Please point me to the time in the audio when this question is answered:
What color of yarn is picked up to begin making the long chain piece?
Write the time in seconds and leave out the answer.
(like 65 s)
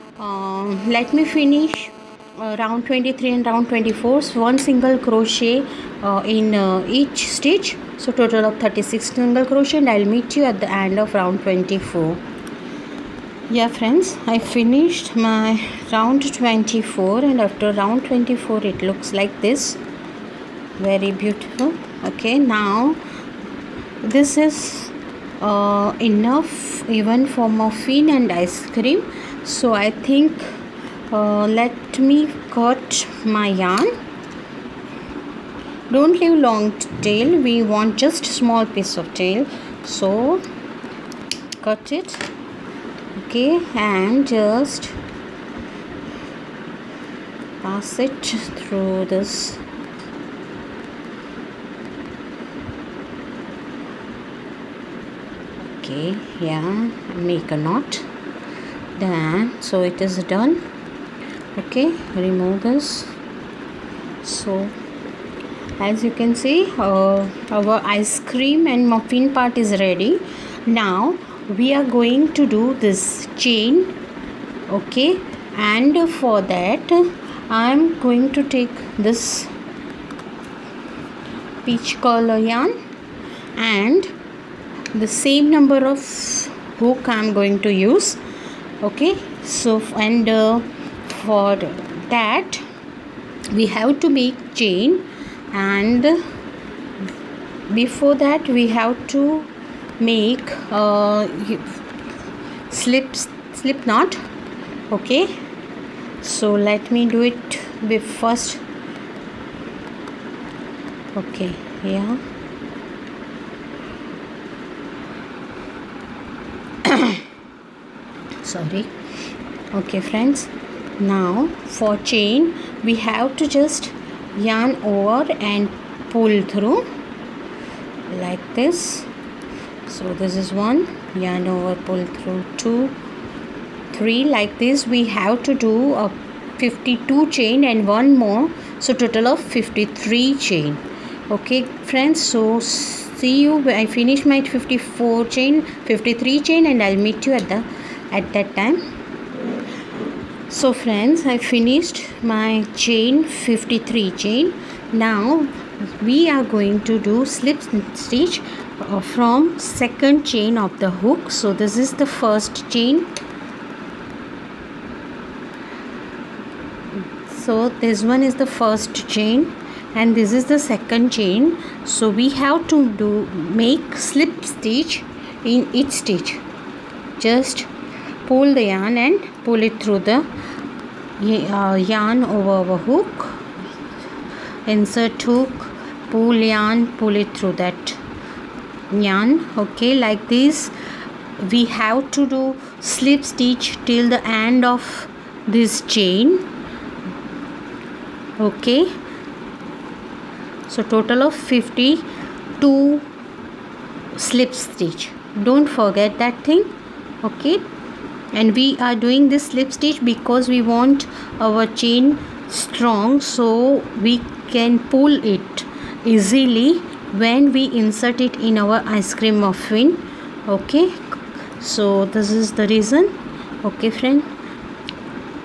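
81 s.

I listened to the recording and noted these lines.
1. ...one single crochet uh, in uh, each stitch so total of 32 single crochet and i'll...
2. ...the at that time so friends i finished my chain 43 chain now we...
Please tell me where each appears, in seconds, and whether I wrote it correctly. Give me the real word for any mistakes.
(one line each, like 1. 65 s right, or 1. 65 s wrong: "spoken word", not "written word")
1. 4 s wrong: "36", not "32"
2. 147 s wrong: "53", not "43".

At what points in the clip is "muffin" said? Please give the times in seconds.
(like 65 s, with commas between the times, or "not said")
27 s, 68 s, 219 s.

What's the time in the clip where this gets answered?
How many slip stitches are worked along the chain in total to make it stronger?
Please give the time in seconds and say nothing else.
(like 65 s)
200 s.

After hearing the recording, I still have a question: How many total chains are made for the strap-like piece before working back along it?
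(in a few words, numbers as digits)
53.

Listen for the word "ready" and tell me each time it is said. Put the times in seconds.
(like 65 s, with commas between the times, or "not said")
69 s.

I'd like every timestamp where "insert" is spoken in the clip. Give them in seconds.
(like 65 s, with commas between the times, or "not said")
184 s, 217 s.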